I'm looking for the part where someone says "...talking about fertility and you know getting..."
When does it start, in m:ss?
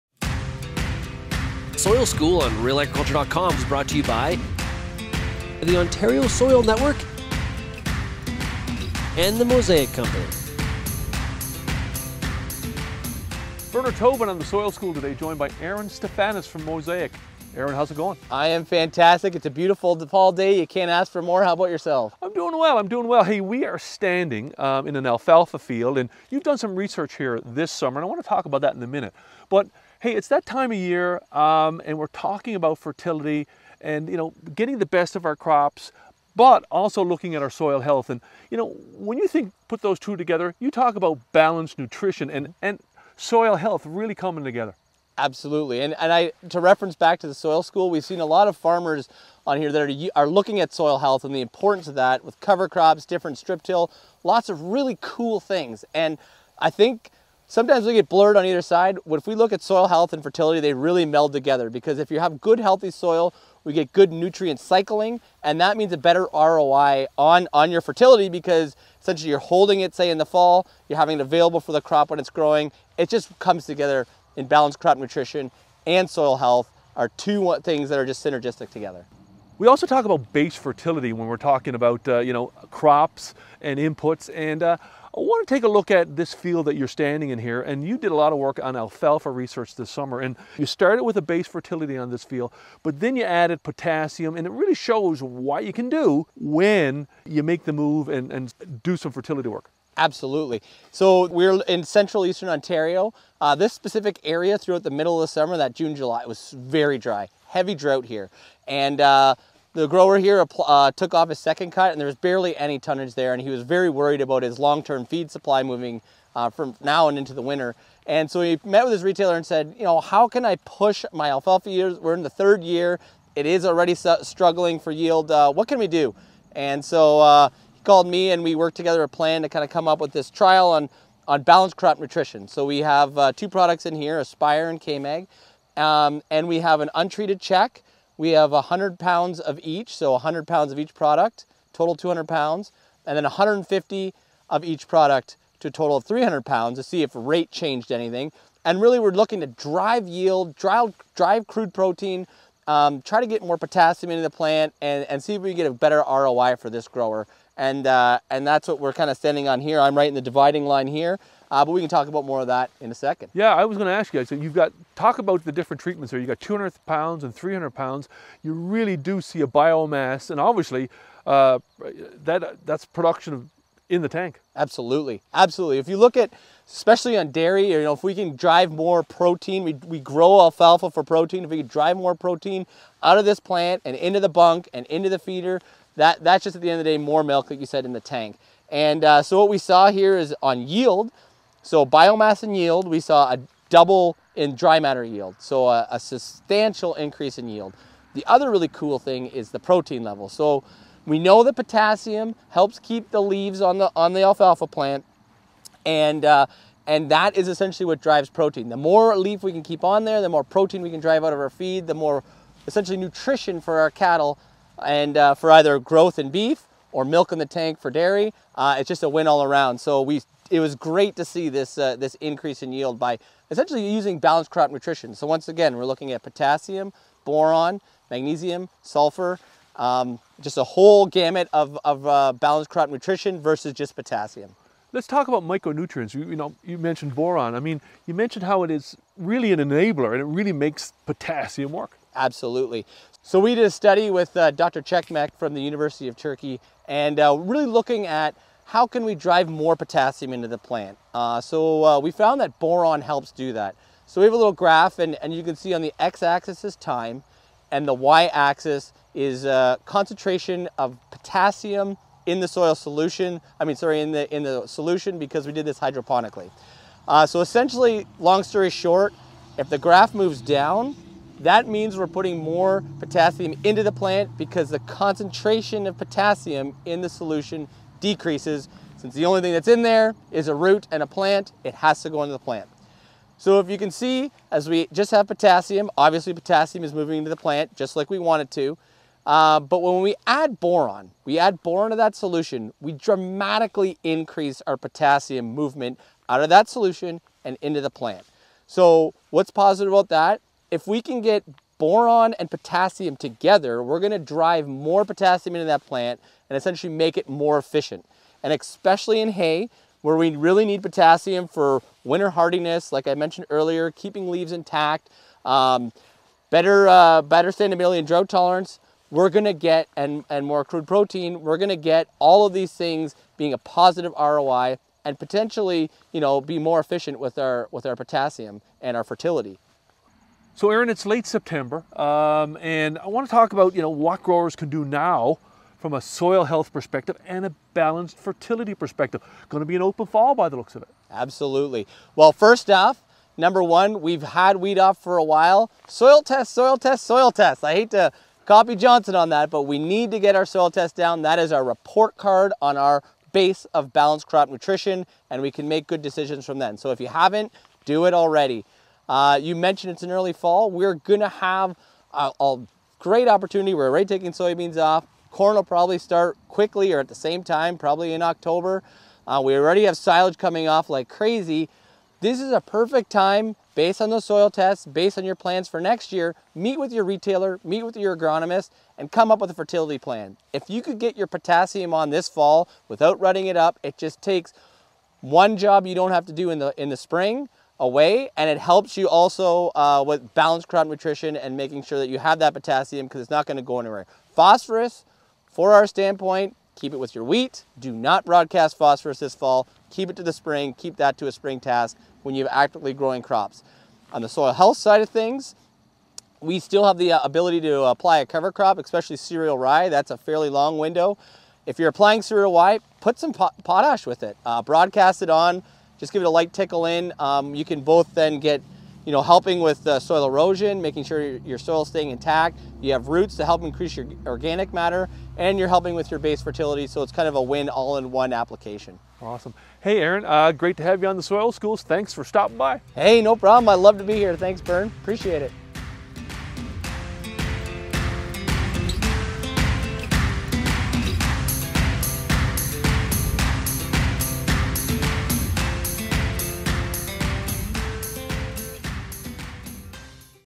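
0:32.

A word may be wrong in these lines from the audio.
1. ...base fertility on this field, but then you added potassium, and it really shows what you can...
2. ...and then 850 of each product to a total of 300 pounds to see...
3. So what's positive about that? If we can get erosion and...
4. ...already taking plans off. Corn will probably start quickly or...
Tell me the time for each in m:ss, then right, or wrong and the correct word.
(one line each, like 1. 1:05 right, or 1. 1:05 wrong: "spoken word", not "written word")
1. 1:31 right
2. 2:23 wrong: "150", not "850"
3. 4:58 wrong: "boron", not "erosion"
4. 6:03 wrong: "soybeans", not "plans".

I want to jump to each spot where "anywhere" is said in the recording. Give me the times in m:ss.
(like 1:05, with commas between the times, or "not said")
6:33.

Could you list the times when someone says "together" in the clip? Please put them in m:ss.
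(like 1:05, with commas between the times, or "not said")
0:40, 0:44, 1:01, 1:13, 1:18, 2:08, 5:03.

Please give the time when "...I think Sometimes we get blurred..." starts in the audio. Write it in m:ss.
0:56.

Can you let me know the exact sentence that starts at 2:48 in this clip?
You really do see a biomass, and obviously, uh, that that's production of in the tank.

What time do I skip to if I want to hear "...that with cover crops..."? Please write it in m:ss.
0:51.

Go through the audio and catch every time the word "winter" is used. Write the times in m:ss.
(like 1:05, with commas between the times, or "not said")
1:57, 5:12.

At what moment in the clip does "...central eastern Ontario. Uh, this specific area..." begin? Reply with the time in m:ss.
1:41.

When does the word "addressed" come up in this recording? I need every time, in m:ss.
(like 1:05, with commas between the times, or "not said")
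not said.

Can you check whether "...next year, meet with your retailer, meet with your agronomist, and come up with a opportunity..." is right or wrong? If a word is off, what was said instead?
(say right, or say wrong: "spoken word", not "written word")
wrong: "fertility", not "opportunity".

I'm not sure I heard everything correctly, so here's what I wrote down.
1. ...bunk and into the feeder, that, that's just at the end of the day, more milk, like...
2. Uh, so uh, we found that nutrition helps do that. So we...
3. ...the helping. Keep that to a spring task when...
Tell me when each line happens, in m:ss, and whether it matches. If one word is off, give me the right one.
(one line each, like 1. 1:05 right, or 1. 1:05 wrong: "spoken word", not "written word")
1. 3:04 right
2. 4:11 wrong: "boron", not "nutrition"
3. 6:40 wrong: "spring", not "helping".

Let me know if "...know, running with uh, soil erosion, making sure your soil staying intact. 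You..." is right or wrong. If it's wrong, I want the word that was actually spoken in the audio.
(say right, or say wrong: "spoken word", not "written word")
wrong: "helping", not "running".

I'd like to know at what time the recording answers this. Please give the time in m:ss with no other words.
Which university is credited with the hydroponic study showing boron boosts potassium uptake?
4:05.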